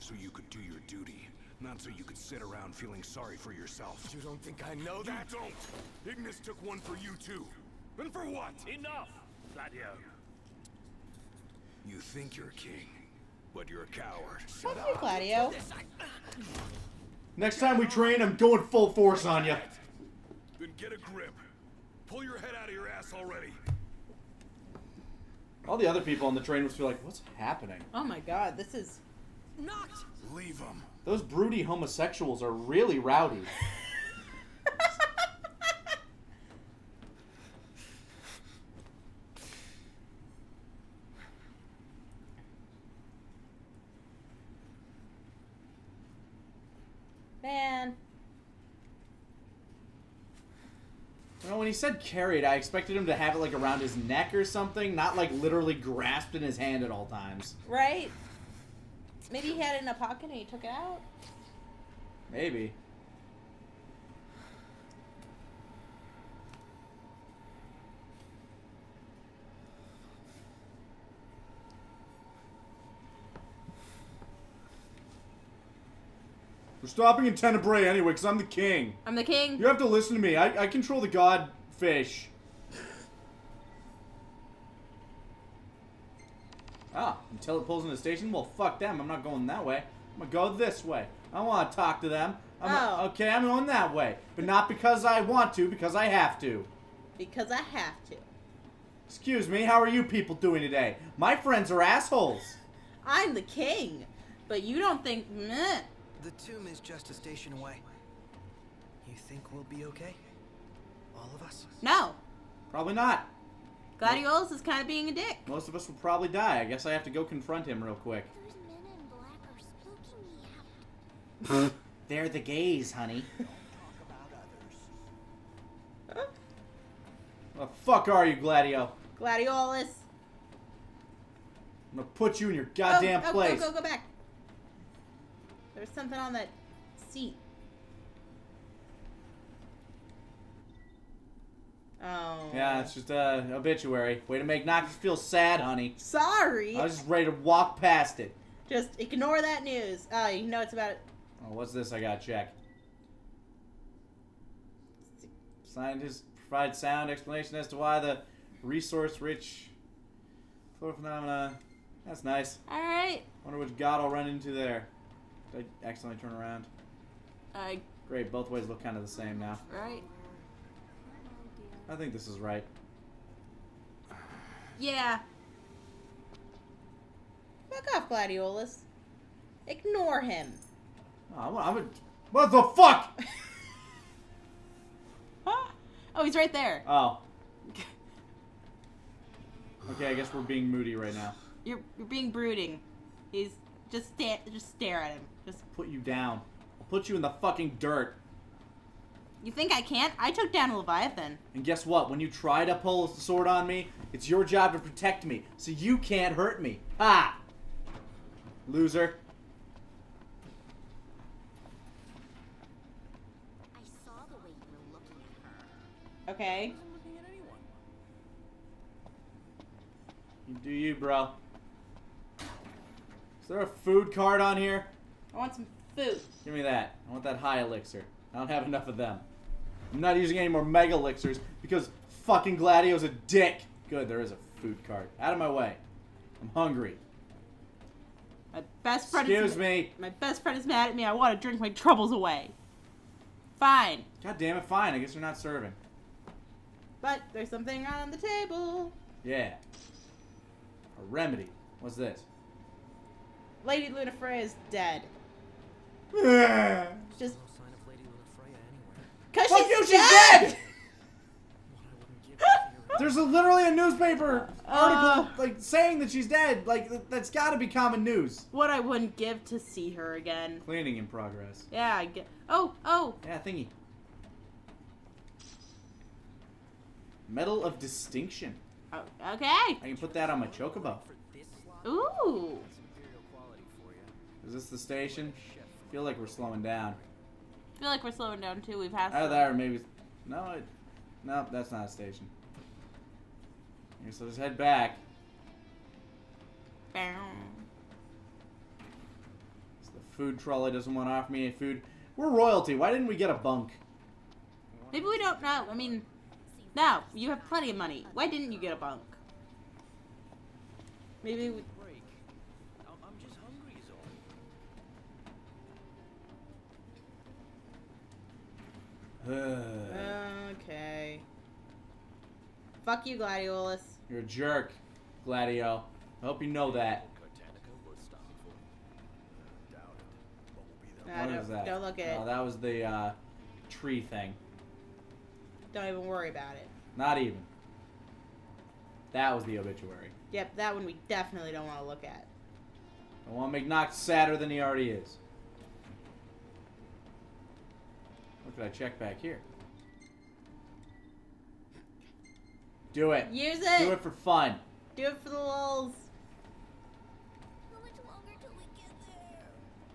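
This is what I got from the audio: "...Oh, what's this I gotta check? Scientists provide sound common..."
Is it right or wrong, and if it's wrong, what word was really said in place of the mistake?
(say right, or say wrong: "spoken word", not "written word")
wrong: "explanation", not "common".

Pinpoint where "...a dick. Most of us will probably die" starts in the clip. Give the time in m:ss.
1:55.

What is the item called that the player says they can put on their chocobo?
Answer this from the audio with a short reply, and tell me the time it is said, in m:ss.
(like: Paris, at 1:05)
Medal of Distinction, at 4:37.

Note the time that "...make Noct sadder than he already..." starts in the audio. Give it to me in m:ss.
5:43.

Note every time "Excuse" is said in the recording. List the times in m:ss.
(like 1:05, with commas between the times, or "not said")
1:39, 3:59.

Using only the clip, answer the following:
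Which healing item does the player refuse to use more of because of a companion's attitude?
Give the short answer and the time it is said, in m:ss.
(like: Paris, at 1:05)
Mega Elixirs, at 3:50.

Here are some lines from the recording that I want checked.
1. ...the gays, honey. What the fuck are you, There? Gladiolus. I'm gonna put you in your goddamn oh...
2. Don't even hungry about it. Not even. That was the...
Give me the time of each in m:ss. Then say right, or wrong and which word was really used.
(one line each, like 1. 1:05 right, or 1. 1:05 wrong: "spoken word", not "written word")
1. 2:02 wrong: "Gladio", not "There"
2. 5:35 wrong: "worry", not "hungry".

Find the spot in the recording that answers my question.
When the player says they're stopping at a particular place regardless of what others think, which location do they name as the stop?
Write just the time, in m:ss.
1:17.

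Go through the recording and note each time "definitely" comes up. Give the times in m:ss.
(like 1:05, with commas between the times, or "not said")
5:41.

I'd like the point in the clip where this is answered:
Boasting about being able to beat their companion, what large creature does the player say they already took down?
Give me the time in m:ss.
3:20.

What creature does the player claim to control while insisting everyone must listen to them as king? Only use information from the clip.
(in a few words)
the god fish.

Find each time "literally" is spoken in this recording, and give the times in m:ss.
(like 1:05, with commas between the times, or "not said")
0:55, 4:23.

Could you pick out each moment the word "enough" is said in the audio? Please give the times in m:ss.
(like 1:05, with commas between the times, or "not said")
0:08, 3:48.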